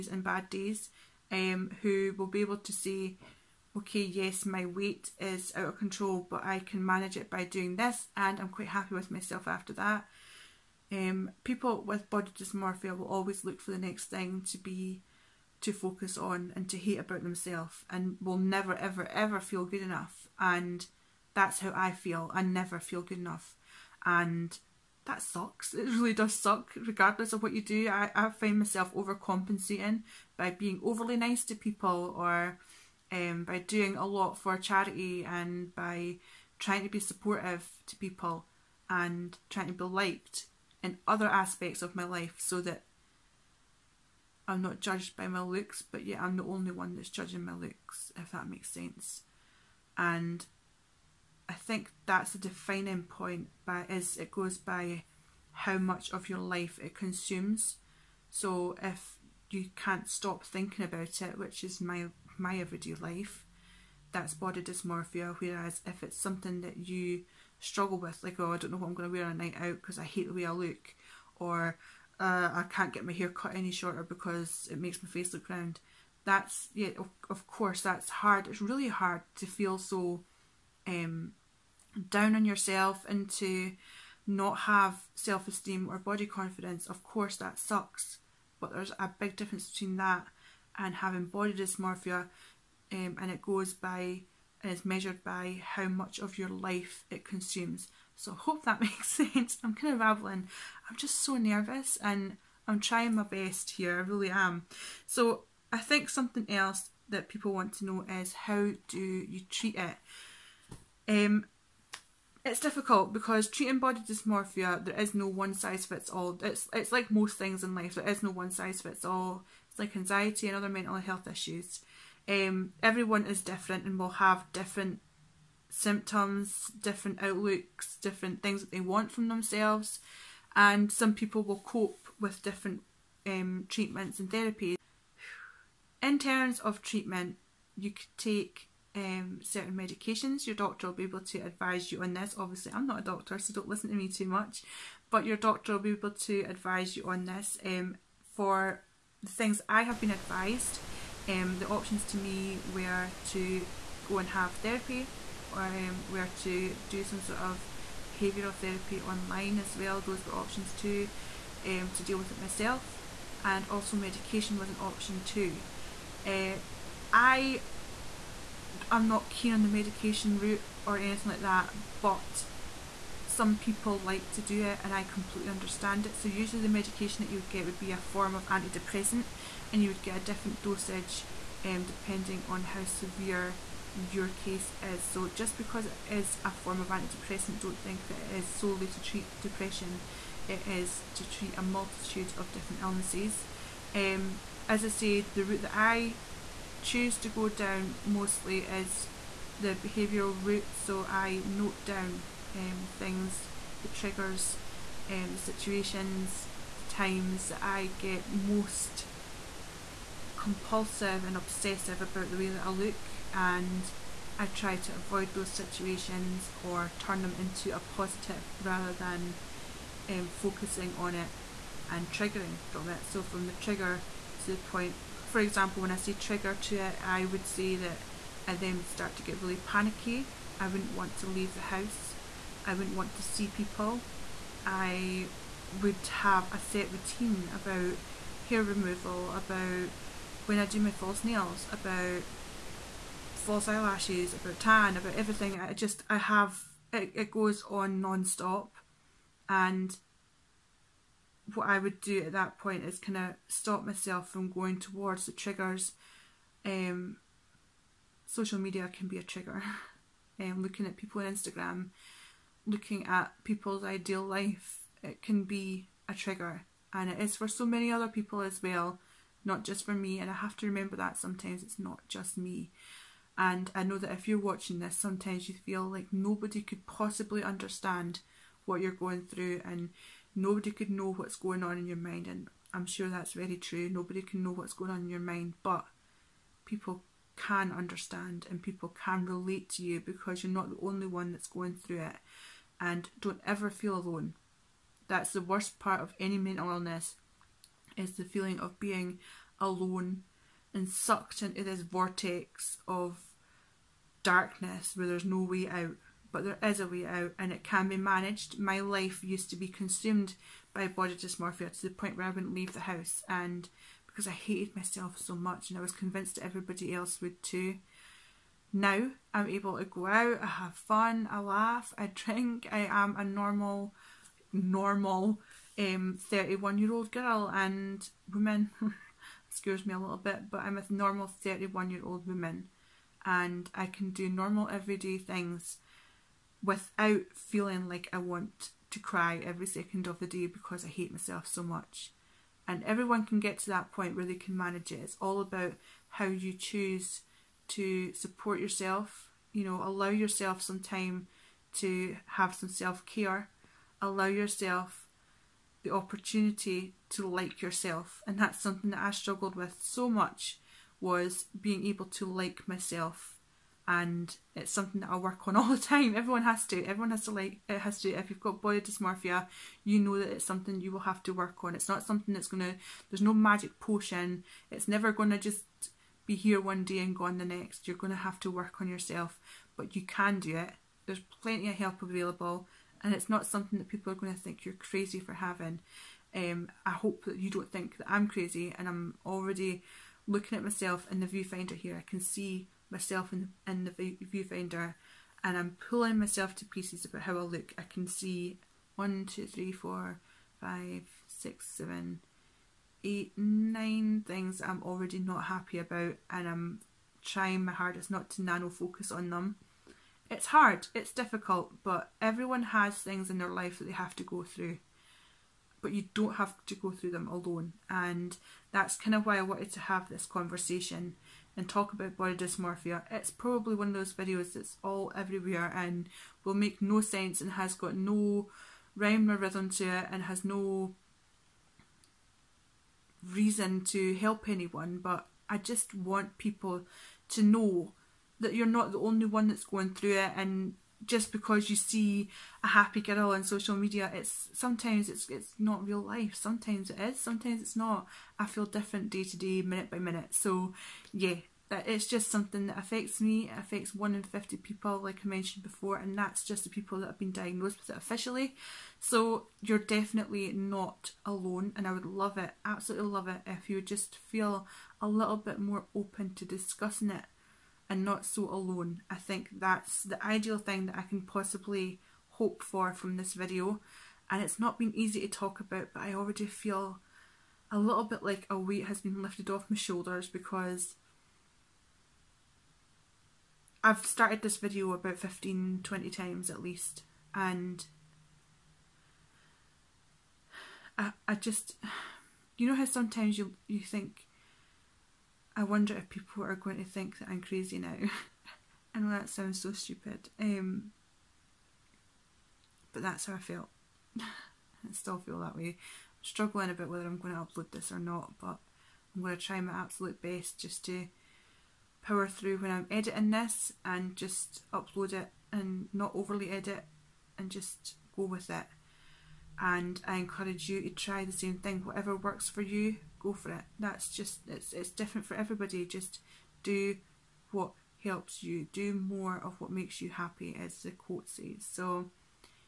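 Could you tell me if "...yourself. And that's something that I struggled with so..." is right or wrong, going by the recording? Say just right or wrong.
right.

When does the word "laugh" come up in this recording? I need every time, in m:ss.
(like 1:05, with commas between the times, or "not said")
5:21.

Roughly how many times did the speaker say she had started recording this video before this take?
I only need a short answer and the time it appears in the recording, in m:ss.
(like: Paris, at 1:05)
15 to 20, at 8:05.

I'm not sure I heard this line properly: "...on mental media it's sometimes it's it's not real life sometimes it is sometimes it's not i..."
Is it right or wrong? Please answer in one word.
wrong.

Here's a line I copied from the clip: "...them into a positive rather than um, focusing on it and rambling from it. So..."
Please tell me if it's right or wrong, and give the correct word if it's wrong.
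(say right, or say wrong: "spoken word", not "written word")
wrong: "triggering", not "rambling".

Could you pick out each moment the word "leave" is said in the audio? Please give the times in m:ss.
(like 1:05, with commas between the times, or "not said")
3:51, 5:12.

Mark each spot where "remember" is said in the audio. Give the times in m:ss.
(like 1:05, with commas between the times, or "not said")
4:30.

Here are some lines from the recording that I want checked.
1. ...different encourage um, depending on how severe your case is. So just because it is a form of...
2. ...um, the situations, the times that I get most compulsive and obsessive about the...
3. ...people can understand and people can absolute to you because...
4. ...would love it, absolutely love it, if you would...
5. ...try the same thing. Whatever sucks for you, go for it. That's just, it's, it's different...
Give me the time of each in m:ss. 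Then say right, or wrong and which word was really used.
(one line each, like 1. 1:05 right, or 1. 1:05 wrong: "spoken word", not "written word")
1. 3:00 wrong: "dosage", not "encourage"
2. 3:25 right
3. 4:46 wrong: "relate", not "absolute"
4. 7:41 right
5. 8:40 wrong: "works", not "sucks".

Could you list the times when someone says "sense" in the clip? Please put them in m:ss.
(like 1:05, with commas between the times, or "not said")
0:48, 1:39, 7:07.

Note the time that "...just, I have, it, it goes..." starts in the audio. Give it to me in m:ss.
4:05.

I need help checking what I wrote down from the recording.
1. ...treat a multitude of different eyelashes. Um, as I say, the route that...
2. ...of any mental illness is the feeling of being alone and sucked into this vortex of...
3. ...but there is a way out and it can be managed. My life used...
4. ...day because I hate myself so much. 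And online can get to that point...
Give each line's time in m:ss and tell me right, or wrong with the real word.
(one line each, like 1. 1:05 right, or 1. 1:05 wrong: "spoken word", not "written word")
1. 3:11 wrong: "illnesses", not "eyelashes"
2. 4:55 right
3. 5:06 right
4. 5:40 wrong: "everyone", not "online".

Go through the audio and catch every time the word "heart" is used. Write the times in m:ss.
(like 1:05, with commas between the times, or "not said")
not said.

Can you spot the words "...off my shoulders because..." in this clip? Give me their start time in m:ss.
7:59.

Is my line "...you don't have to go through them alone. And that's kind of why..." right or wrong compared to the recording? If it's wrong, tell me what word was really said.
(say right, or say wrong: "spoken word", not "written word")
right.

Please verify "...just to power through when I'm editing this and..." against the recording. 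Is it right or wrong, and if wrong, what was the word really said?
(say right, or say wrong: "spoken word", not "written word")
right.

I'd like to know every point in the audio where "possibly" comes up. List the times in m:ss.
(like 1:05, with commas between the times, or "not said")
4:36, 7:51.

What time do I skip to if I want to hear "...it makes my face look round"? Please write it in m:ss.
1:14.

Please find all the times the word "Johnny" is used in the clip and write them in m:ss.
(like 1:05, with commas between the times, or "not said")
not said.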